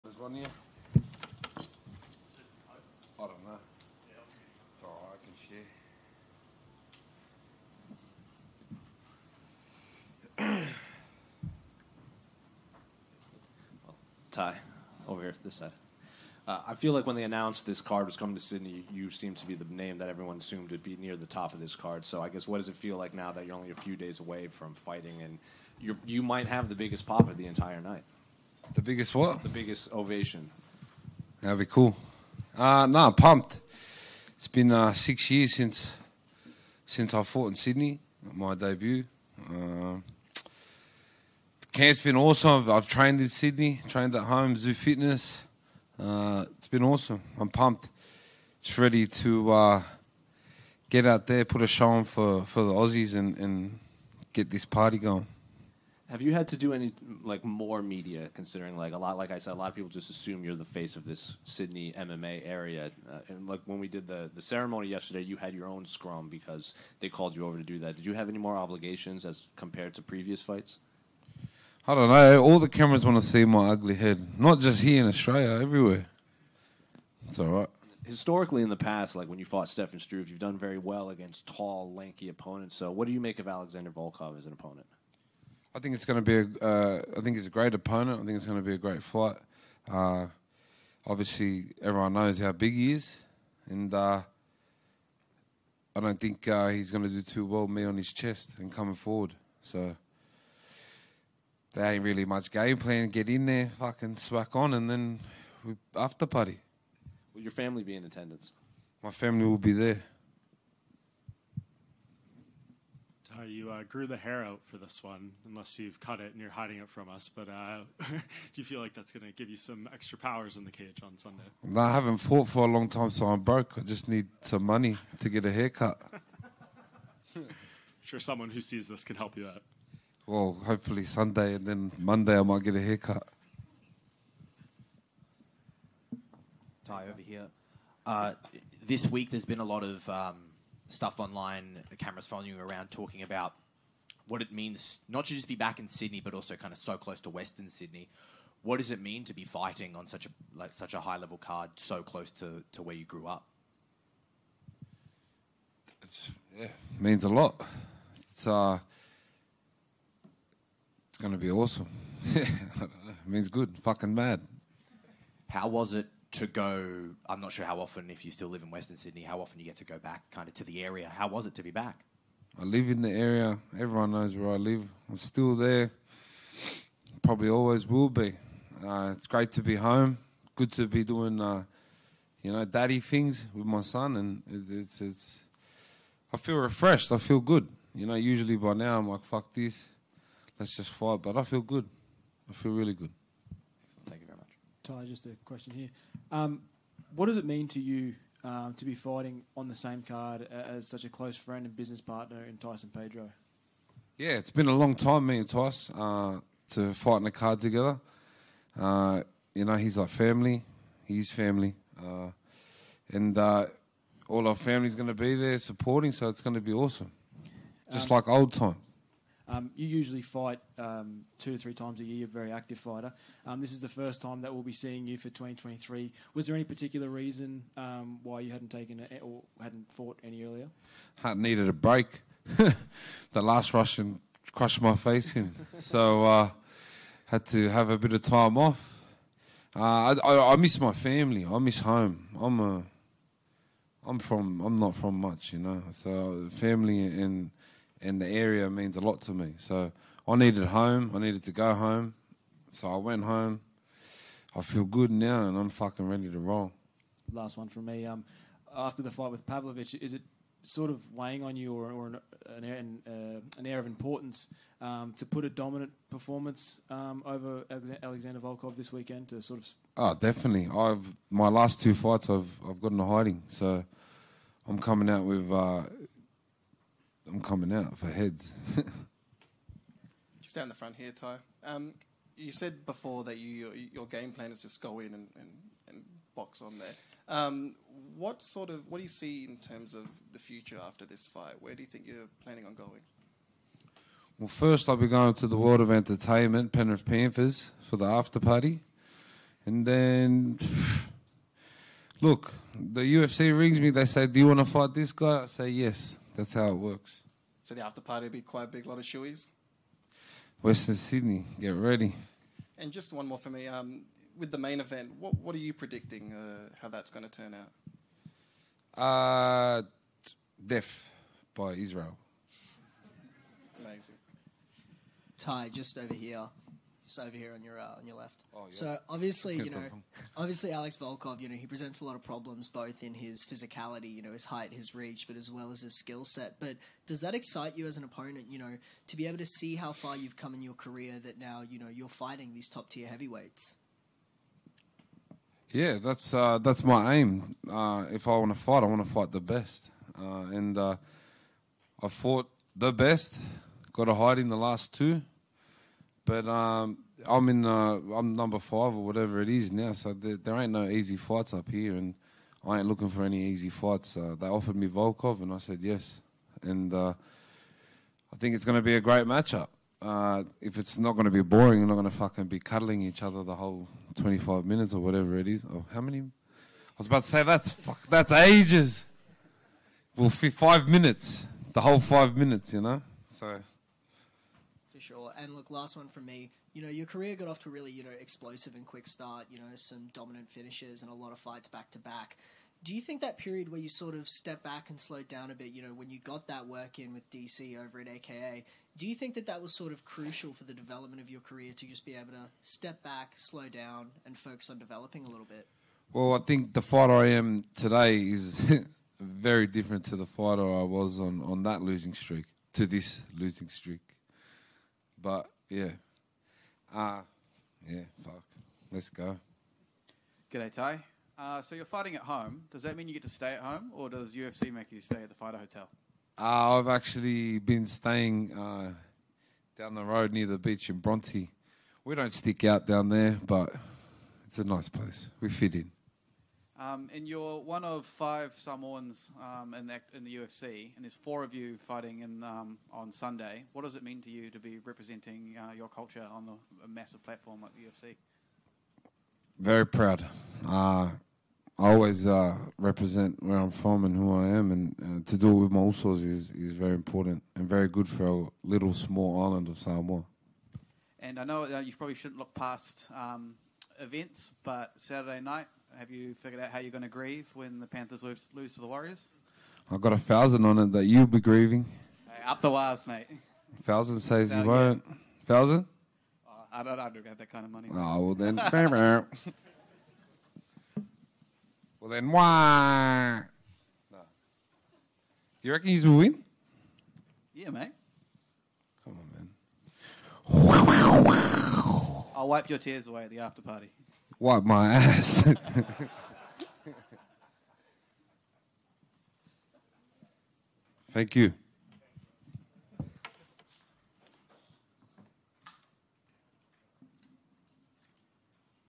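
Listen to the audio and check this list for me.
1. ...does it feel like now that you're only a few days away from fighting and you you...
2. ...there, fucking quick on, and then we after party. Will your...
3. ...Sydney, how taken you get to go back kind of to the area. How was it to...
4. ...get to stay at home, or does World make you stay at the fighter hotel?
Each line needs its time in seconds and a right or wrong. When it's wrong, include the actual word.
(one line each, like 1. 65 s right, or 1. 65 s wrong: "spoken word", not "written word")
1. 22 s right
2. 103 s wrong: "swack", not "quick"
3. 168 s wrong: "often", not "taken"
4. 423 s wrong: "UFC", not "World".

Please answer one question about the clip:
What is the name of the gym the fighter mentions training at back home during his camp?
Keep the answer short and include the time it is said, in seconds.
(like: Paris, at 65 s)
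Zoo Fitness, at 44 s.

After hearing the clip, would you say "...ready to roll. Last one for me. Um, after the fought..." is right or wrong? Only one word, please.
wrong.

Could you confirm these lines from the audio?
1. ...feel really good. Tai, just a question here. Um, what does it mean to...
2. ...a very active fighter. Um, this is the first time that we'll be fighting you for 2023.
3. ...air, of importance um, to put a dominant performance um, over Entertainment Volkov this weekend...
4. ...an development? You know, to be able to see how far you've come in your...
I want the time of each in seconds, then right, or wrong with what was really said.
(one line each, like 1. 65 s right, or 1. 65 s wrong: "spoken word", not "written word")
1. 192 s right
2. 222 s wrong: "seeing", not "fighting"
3. 263 s wrong: "Alexander", not "Entertainment"
4. 337 s wrong: "opponent", not "development".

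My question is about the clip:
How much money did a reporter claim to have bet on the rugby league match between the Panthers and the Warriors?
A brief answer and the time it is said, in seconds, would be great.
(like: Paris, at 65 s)
1000, at 470 s.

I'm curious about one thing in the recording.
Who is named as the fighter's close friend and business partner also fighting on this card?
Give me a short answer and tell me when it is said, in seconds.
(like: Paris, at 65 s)
Tyson Pedro, at 202 s.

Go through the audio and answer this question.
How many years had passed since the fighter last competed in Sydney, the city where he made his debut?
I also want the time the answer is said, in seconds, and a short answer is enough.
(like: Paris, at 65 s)
6, at 34 s.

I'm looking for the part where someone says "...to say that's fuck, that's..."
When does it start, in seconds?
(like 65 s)
377 s.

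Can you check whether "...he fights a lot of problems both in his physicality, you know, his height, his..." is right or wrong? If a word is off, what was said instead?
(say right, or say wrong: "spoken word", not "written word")
wrong: "presents", not "fights".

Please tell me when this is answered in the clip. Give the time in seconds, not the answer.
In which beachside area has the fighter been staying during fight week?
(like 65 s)
430 s.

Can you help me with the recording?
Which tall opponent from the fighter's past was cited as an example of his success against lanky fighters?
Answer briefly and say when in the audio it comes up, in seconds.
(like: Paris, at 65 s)
Stefan Struve, at 79 s.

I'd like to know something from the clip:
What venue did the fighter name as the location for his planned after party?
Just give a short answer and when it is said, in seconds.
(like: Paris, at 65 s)
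Penrith Panthers, at 296 s.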